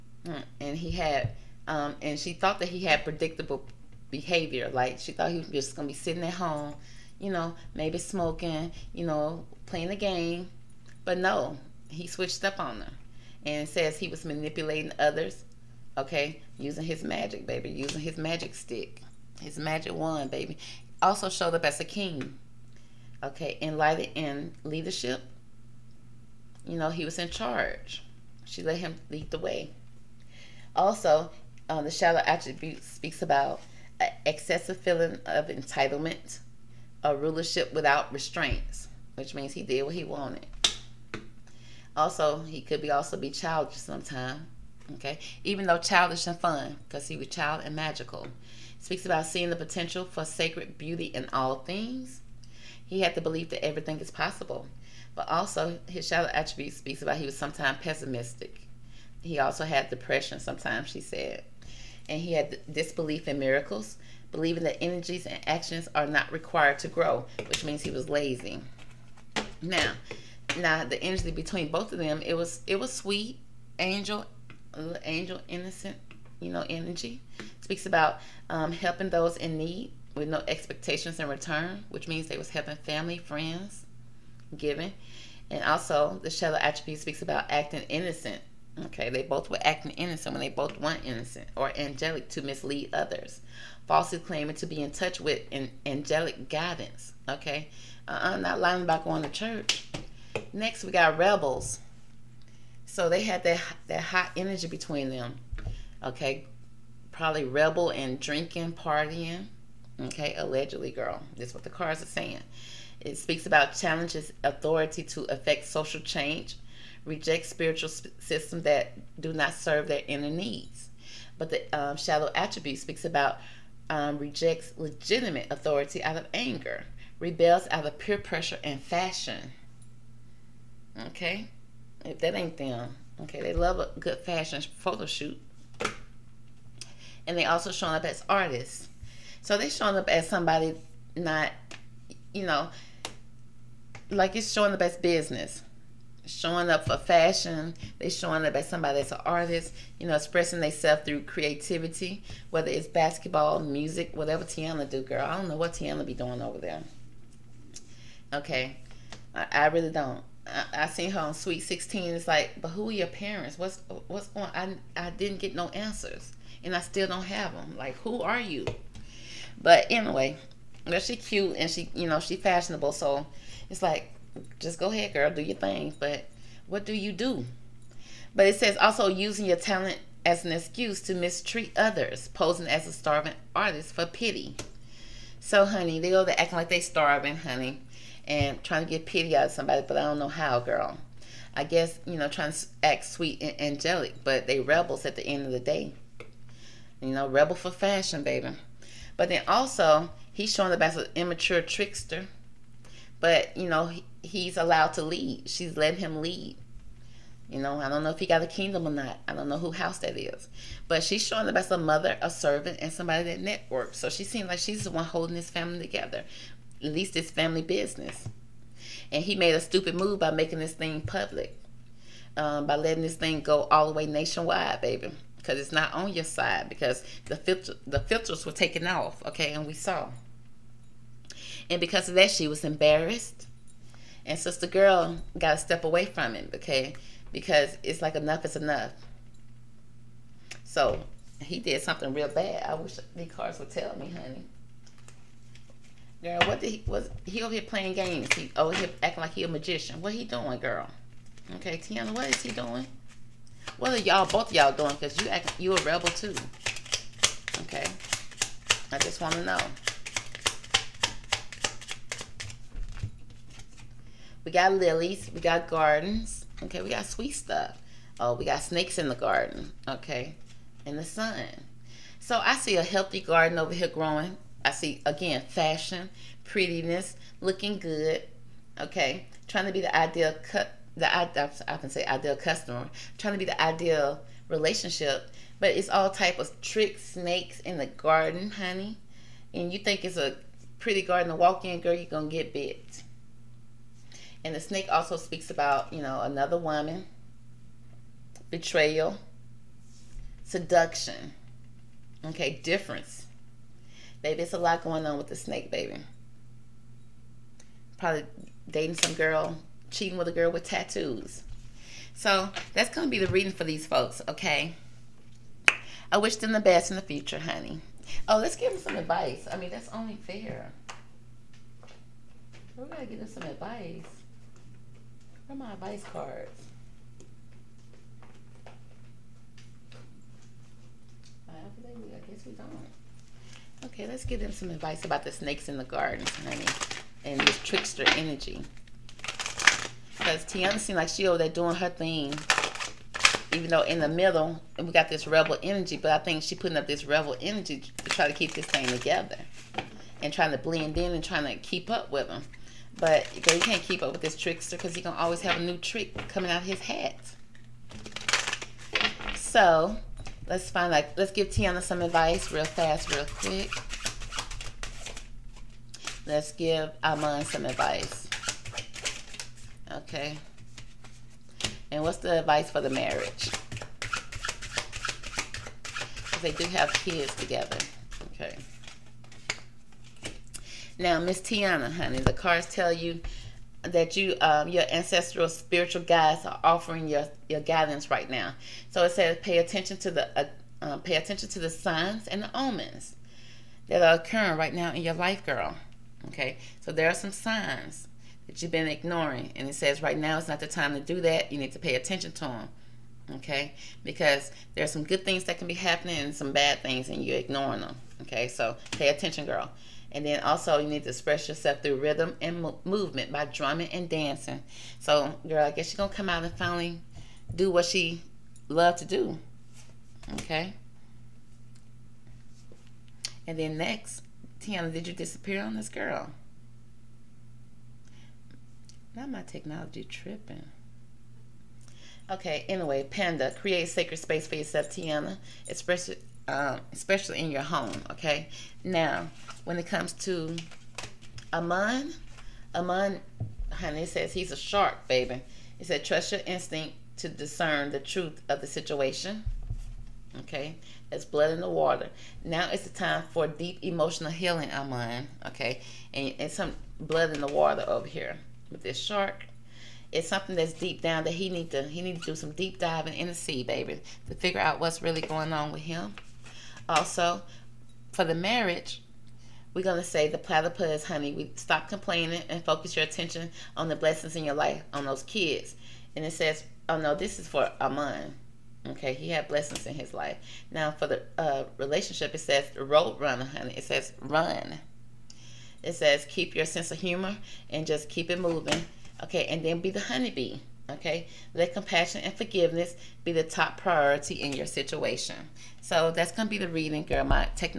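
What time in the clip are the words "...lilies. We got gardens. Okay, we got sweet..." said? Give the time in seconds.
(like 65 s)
264 s.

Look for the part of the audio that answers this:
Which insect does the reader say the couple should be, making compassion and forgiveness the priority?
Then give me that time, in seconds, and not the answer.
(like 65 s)
490 s.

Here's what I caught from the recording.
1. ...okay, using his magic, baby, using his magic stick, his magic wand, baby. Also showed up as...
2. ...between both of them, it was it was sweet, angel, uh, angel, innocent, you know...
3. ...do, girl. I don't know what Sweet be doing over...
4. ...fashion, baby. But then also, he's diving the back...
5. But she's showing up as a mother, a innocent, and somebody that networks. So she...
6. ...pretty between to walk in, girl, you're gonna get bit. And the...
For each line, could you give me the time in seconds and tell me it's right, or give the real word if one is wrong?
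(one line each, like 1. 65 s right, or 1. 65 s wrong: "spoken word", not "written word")
1. 15 s right
2. 71 s right
3. 154 s wrong: "Teyana", not "Sweet"
4. 197 s wrong: "showing", not "diving"
5. 210 s wrong: "servant", not "innocent"
6. 290 s wrong: "garden", not "between".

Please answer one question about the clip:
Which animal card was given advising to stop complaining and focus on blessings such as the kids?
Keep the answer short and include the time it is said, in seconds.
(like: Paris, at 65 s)
Platypus, at 470 s.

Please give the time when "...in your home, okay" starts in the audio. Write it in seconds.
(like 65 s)
437 s.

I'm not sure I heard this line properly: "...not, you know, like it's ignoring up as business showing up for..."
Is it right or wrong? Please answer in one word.
wrong.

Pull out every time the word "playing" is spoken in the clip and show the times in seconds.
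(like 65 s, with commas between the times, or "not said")
9 s, 247 s.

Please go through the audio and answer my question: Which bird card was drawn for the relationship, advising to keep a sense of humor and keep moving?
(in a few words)
Road runner.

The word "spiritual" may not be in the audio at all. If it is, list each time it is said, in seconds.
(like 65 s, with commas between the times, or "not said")
117 s, 385 s.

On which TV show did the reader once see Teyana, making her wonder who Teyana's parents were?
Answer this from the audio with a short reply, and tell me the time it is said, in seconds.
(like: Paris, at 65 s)
Sweet 16, at 161 s.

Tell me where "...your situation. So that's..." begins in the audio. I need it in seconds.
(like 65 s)
494 s.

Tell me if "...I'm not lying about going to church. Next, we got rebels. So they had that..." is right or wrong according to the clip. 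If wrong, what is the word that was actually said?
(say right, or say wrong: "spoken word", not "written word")
right.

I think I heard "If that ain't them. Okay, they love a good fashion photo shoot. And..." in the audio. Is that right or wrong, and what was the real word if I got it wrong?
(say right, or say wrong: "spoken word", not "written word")
right.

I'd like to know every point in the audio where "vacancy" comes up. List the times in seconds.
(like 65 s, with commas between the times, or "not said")
not said.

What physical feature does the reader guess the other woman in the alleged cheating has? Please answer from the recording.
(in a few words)
Tattoos.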